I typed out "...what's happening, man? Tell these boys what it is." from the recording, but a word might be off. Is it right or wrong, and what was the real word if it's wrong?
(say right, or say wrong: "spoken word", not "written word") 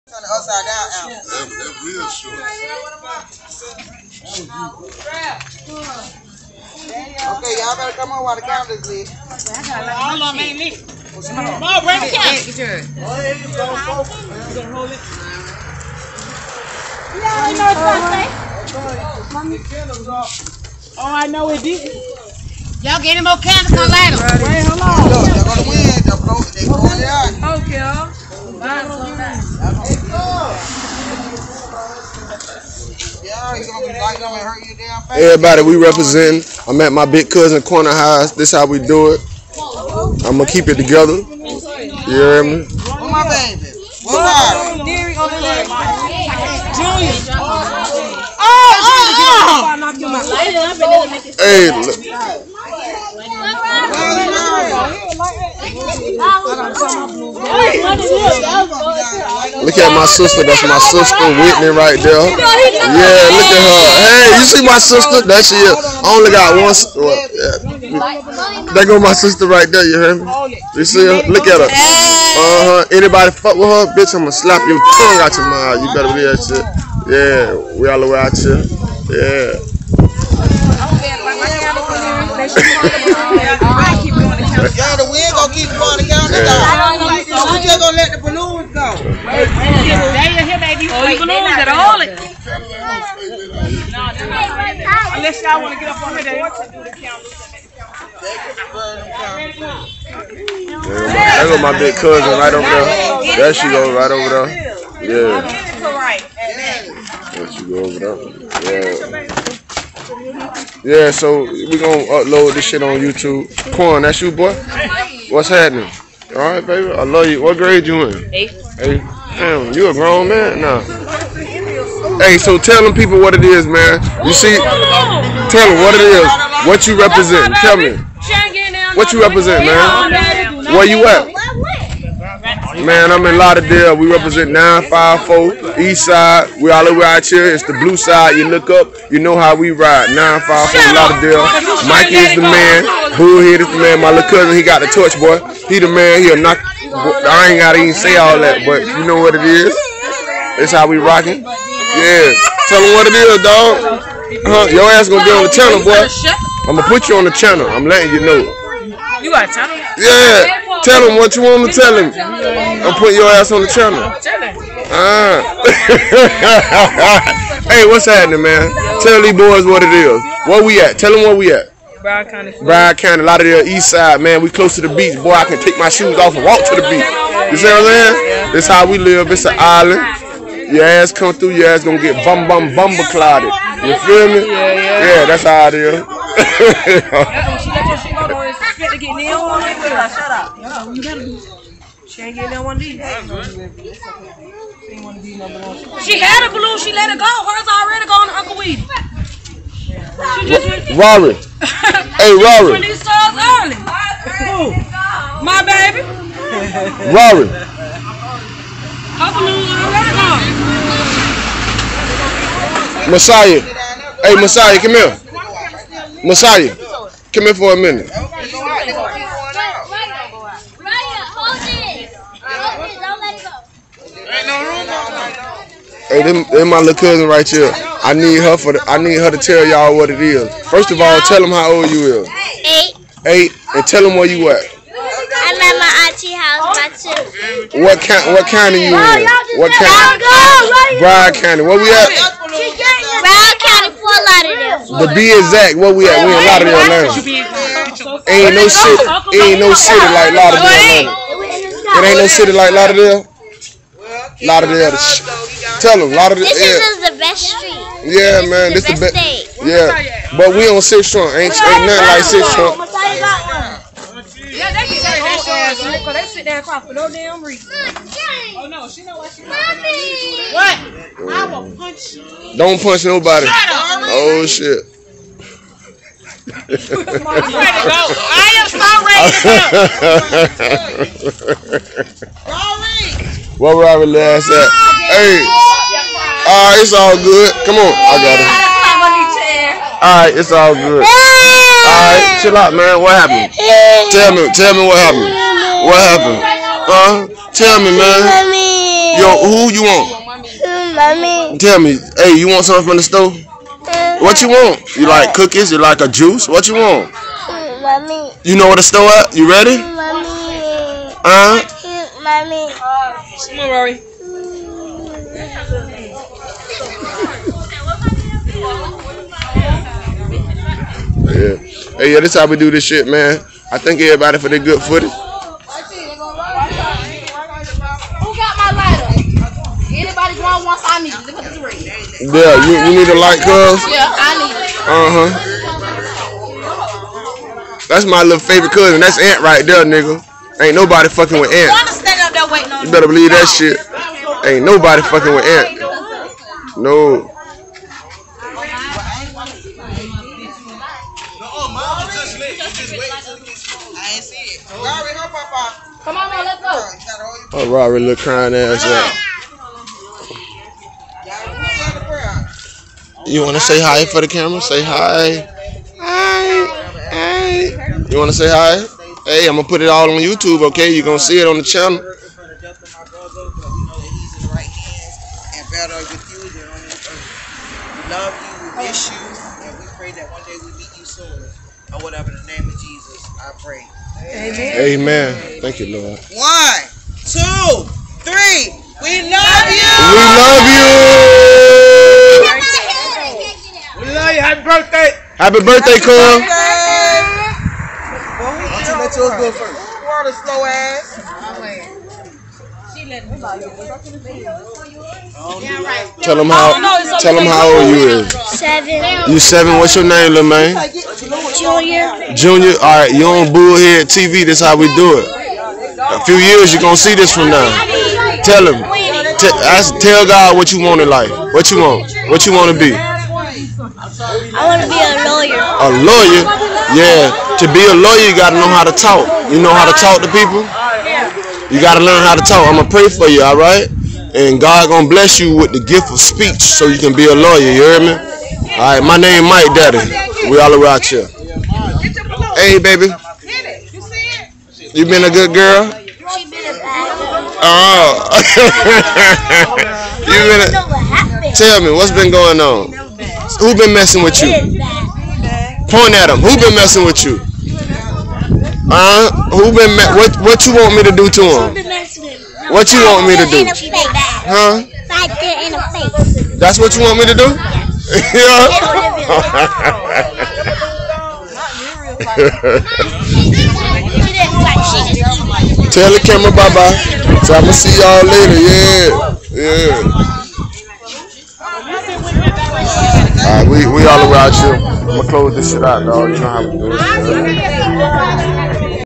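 right.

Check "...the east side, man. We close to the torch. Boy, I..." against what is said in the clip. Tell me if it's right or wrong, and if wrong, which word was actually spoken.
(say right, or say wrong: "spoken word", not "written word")
wrong: "beach", not "torch".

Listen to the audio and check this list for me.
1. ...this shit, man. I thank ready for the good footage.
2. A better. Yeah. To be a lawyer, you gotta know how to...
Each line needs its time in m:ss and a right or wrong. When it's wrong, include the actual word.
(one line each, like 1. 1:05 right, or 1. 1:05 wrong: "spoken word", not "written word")
1. 5:22 wrong: "everybody", not "ready"
2. 7:05 wrong: "lawyer", not "better".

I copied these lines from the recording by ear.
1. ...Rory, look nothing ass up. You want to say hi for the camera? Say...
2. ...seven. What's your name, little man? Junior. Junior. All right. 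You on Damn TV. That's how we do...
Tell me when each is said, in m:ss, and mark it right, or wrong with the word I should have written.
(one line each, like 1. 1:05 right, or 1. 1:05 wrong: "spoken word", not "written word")
1. 5:57 wrong: "crying", not "nothing"
2. 6:49 wrong: "Bullhead", not "Damn".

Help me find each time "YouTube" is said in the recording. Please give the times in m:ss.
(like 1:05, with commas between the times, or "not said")
1:52, 6:10.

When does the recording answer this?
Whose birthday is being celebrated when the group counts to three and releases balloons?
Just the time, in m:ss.
6:35.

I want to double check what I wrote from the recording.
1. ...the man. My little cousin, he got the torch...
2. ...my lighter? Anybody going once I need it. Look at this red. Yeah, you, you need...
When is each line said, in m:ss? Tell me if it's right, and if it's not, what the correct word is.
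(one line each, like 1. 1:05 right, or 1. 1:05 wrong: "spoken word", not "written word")
1. 2:23 right
2. 5:28 right.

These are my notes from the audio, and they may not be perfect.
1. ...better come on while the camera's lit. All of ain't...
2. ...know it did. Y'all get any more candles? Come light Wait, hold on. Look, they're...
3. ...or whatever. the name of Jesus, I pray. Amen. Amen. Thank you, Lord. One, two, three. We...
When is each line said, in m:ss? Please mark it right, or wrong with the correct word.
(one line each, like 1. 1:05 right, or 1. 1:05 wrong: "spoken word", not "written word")
1. 0:07 right
2. 0:21 right
3. 6:21 right.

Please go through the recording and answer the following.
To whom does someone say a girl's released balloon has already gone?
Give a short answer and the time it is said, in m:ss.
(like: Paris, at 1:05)
Uncle Weedy, at 3:18.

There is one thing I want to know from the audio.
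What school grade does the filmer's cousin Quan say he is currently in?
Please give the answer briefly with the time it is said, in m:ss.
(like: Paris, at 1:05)
Eighth, at 1:58.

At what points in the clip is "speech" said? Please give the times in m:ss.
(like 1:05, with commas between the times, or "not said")
7:16.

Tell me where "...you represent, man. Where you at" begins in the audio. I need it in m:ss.
2:09.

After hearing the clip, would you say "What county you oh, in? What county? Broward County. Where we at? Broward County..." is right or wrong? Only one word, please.
right.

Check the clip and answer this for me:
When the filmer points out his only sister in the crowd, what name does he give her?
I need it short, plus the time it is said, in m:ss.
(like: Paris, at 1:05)
Whitney, at 1:01.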